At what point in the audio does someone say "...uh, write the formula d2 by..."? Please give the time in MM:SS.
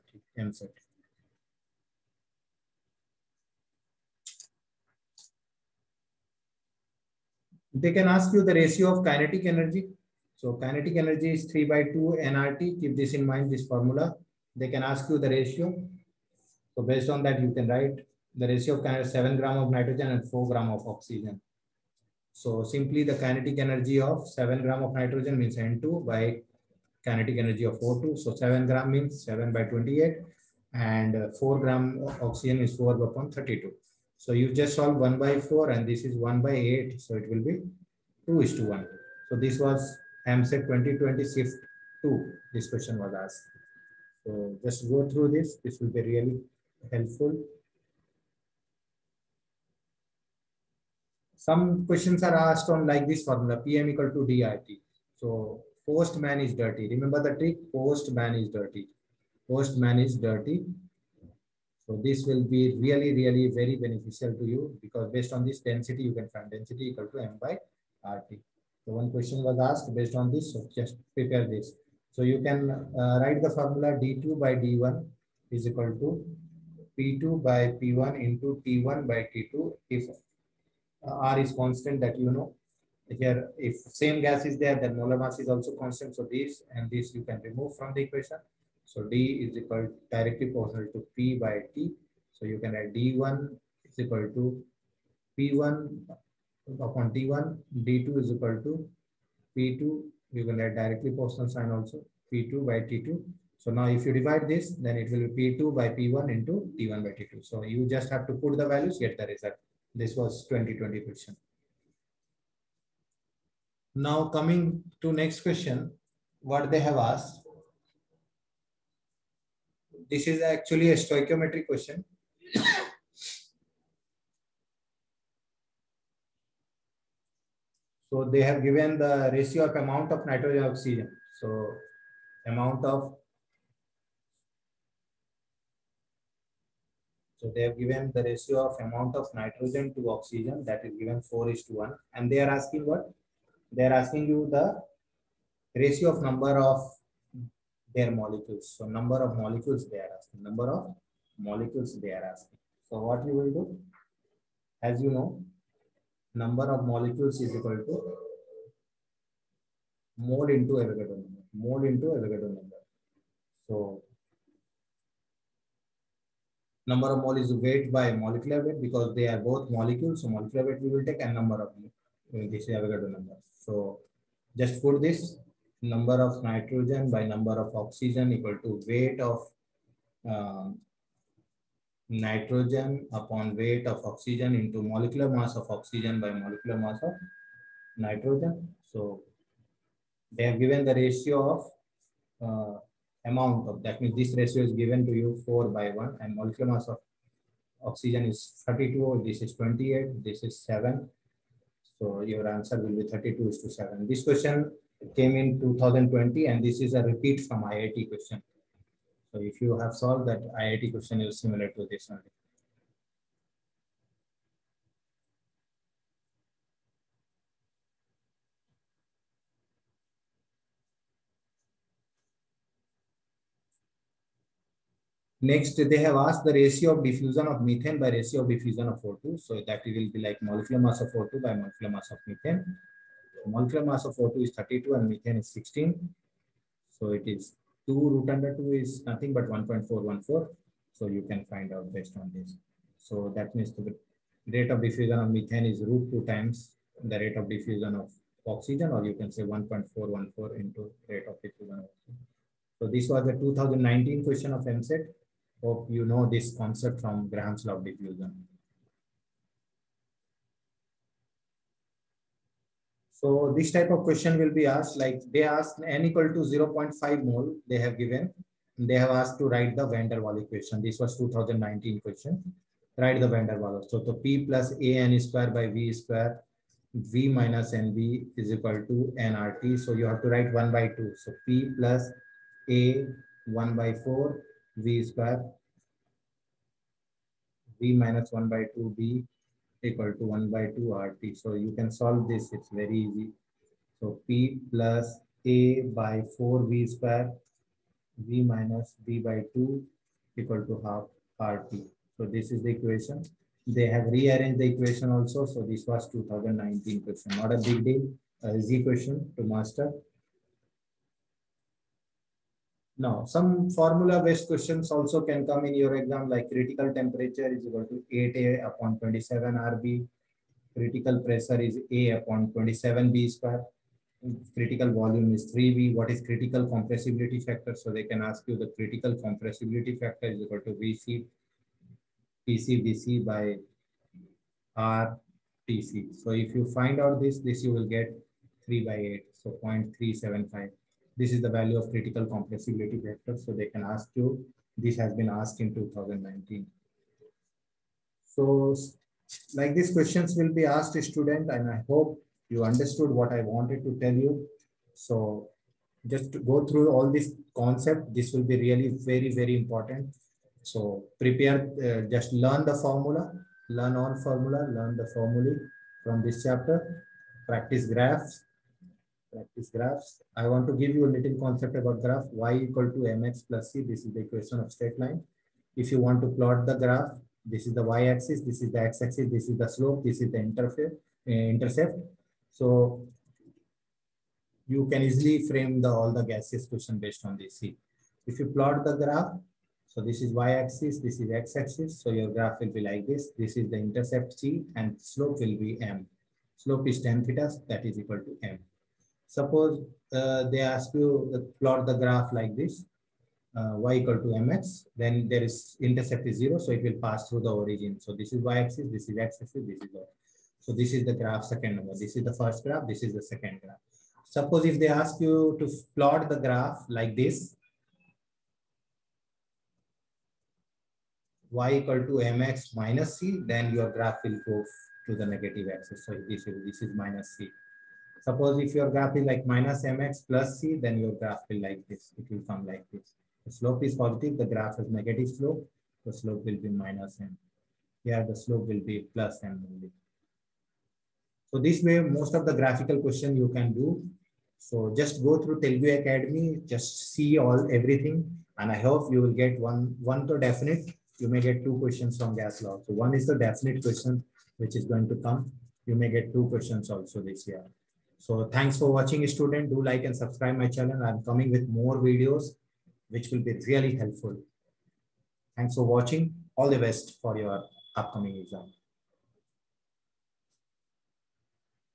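01:12.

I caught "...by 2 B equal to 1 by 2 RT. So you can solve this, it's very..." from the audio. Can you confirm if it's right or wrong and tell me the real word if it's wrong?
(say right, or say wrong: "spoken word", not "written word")
right.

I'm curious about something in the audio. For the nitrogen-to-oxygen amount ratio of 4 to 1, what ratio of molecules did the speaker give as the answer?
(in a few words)
32:7.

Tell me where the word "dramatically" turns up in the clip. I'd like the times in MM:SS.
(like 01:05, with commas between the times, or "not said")
not said.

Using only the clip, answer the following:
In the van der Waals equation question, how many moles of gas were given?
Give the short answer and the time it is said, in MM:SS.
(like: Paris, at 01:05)
0.5, at 04:26.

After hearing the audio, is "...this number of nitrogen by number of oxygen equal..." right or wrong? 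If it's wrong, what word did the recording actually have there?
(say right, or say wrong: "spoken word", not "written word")
right.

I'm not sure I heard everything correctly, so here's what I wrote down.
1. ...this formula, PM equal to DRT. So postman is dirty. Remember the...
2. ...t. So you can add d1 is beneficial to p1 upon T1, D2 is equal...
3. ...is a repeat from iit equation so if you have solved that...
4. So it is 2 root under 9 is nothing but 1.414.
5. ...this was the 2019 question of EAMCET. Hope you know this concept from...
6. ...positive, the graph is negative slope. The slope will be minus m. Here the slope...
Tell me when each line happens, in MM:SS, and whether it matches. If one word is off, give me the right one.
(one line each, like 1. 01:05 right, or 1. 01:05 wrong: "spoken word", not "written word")
1. 00:53 right
2. 01:31 wrong: "equal", not "beneficial"
3. 03:26 wrong: "question", not "equation"
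4. 03:56 wrong: "2", not "9"
5. 04:12 right
6. 07:13 right.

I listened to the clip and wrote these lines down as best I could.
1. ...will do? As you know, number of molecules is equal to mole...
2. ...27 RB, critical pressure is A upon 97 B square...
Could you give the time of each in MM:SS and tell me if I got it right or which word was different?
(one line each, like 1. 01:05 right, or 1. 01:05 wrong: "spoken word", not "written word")
1. 02:33 right
2. 05:18 wrong: "27", not "97".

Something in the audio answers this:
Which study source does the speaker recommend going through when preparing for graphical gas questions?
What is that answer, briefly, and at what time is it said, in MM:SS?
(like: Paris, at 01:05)
Telugu Academy, at 07:25.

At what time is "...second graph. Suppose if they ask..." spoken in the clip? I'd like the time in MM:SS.
06:53.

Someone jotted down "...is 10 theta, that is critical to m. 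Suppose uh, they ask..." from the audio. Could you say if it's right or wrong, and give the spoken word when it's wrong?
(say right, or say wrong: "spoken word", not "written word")
wrong: "equal", not "critical".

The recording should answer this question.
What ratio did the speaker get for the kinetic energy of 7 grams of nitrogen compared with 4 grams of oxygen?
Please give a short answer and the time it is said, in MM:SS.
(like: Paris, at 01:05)
2:1, at 00:38.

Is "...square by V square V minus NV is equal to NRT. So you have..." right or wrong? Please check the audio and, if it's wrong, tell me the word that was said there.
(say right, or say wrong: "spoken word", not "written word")
right.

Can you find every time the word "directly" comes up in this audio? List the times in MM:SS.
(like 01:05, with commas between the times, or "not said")
01:30, 01:40.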